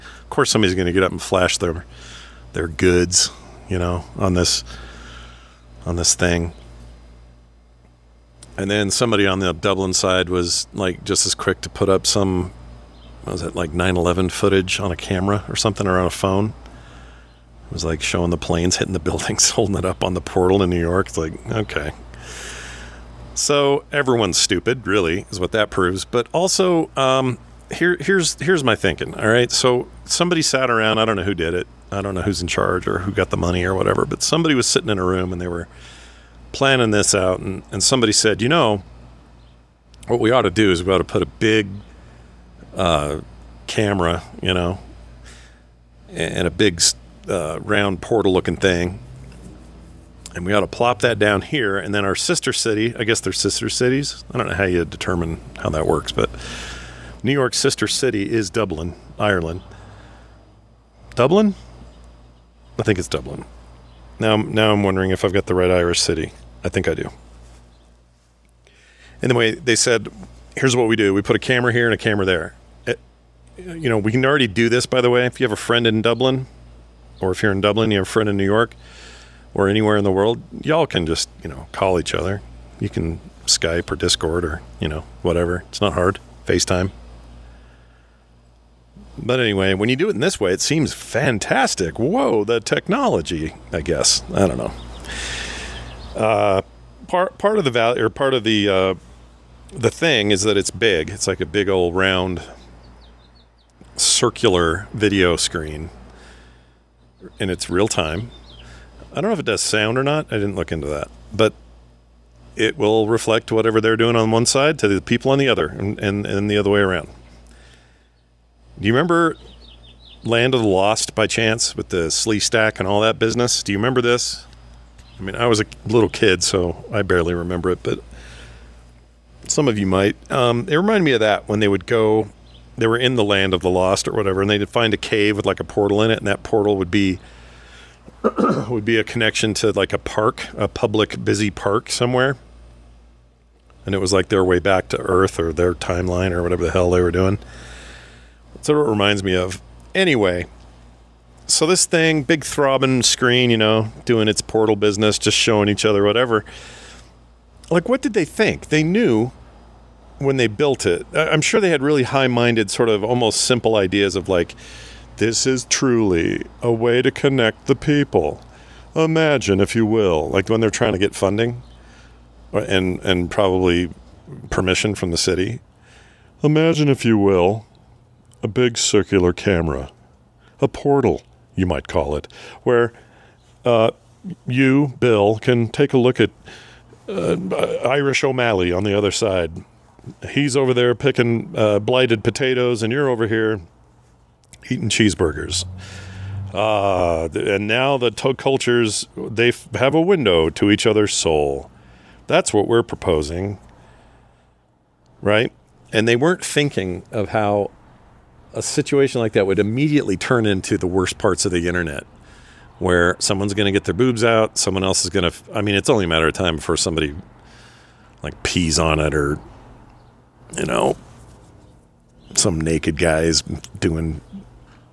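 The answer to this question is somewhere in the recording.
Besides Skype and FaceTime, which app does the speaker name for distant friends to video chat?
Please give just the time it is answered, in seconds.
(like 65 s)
83 s.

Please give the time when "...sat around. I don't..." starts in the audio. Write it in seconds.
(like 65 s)
30 s.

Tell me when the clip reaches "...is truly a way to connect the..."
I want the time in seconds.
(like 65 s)
165 s.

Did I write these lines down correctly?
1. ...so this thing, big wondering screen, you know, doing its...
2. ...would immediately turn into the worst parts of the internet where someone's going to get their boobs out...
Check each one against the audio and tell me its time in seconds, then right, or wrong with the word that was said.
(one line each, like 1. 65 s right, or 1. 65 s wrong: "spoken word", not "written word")
1. 151 s wrong: "throbbing", not "wondering"
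2. 209 s right.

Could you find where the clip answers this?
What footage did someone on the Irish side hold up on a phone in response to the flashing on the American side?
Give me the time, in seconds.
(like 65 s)
13 s.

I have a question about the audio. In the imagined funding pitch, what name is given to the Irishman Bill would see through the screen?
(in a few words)
Irish O'Malley.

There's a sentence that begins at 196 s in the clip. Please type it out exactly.
Uh, and now the two cultures they f- have a window to each other's soul.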